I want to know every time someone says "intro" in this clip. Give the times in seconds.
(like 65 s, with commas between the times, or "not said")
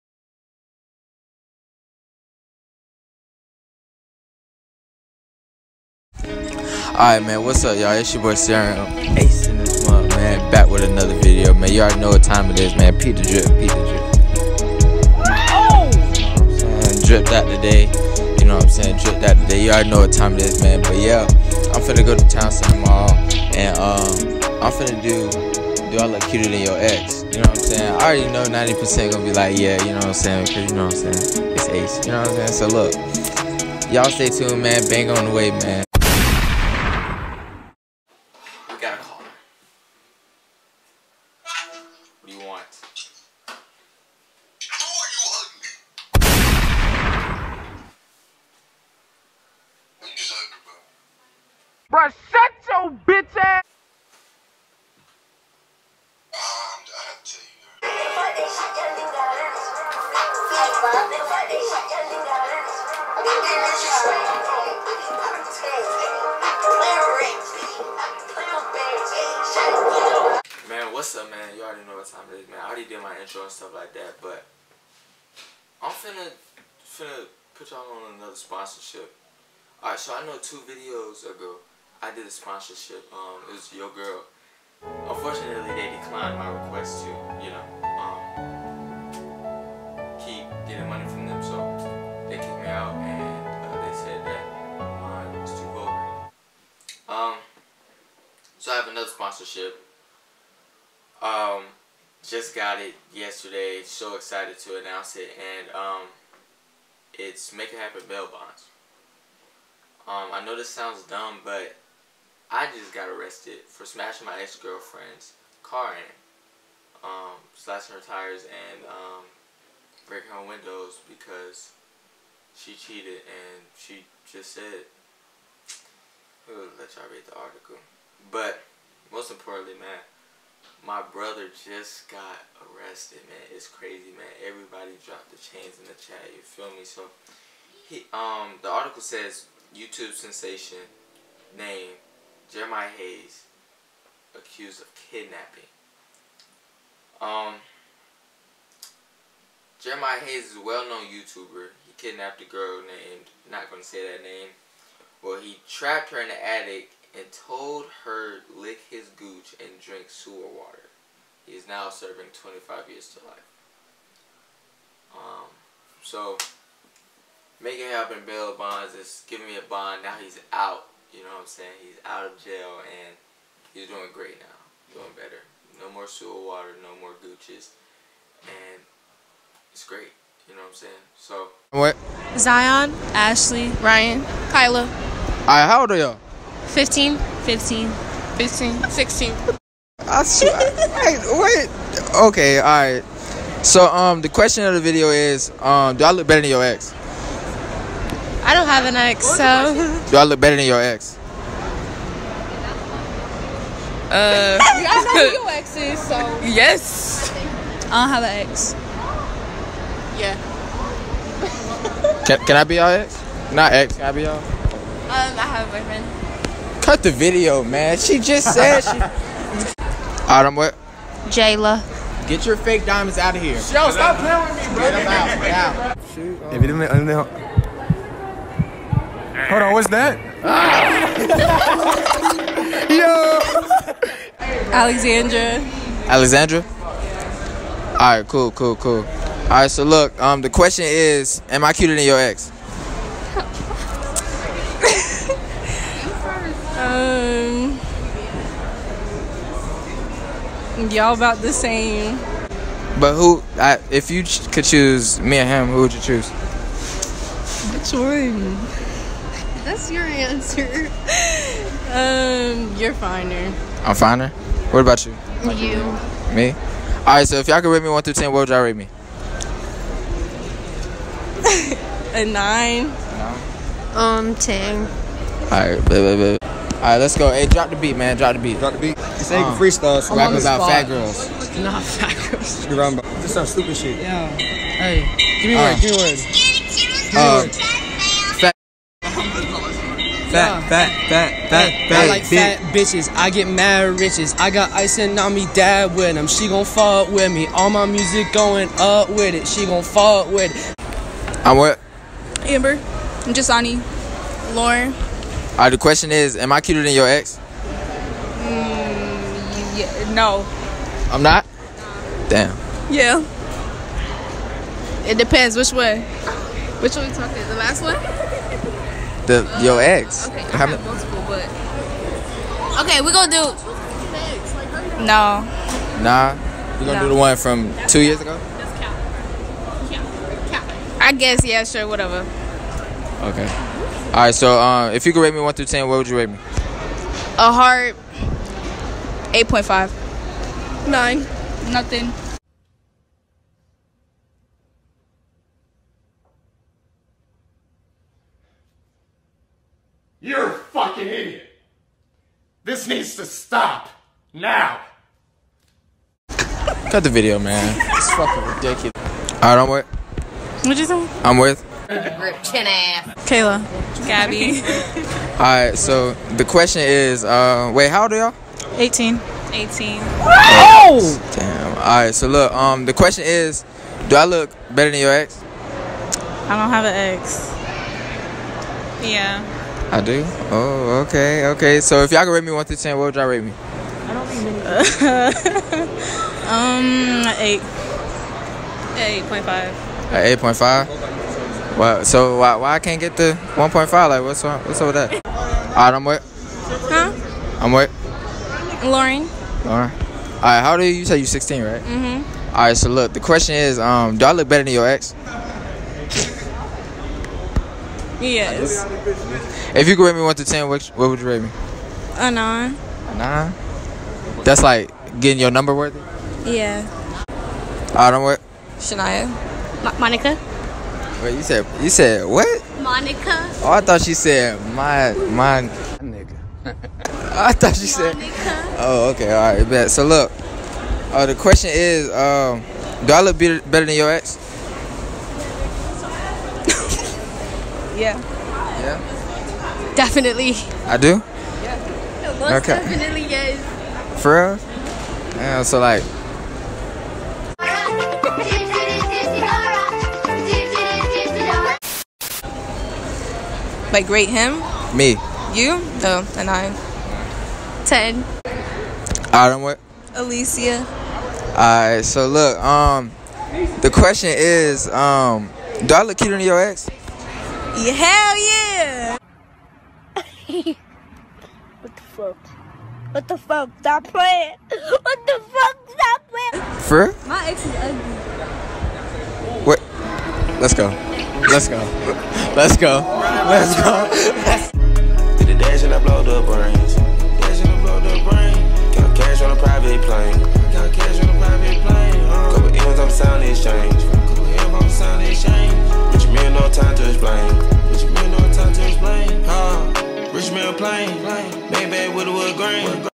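73 s.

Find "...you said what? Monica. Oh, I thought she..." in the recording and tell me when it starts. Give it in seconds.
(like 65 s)
421 s.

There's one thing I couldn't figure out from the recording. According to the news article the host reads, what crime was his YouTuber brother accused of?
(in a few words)
kidnapping.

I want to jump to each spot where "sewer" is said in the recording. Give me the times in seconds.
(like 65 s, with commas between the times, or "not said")
160 s, 176 s.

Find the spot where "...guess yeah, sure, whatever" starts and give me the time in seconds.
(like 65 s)
331 s.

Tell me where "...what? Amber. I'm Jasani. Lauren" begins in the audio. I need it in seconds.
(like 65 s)
301 s.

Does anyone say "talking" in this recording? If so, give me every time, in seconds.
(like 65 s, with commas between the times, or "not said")
317 s.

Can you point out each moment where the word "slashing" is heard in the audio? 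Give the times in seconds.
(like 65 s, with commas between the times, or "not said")
117 s.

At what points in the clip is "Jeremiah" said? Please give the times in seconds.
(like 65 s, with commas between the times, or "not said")
142 s, 149 s.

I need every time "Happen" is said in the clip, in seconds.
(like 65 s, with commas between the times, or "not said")
107 s, 167 s.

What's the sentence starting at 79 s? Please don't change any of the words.
Alright, so I know two videos ago, I did a sponsorship.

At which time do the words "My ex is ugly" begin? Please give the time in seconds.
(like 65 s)
477 s.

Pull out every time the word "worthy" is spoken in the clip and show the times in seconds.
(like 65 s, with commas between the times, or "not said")
415 s.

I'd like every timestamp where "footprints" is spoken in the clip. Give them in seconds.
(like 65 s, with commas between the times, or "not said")
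not said.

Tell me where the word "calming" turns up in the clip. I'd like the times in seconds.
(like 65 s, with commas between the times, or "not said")
not said.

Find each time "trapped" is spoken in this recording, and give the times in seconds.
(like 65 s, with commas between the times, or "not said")
155 s.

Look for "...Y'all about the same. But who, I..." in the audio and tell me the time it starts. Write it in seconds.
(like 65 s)
250 s.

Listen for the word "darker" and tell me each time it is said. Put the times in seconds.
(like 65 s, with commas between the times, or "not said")
not said.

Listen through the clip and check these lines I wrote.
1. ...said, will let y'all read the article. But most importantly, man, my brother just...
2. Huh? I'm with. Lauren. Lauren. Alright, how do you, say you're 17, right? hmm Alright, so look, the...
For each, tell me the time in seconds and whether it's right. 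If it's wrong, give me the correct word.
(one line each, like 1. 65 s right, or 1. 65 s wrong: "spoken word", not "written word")
1. 124 s right
2. 396 s wrong: "16", not "17".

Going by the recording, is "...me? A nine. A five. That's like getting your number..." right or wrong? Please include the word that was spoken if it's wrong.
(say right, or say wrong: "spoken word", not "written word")
wrong: "nine", not "five".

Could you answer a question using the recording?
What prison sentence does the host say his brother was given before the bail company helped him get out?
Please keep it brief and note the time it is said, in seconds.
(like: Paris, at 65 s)
25 years to life, at 162 s.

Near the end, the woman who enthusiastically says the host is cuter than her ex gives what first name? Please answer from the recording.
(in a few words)
Alicia.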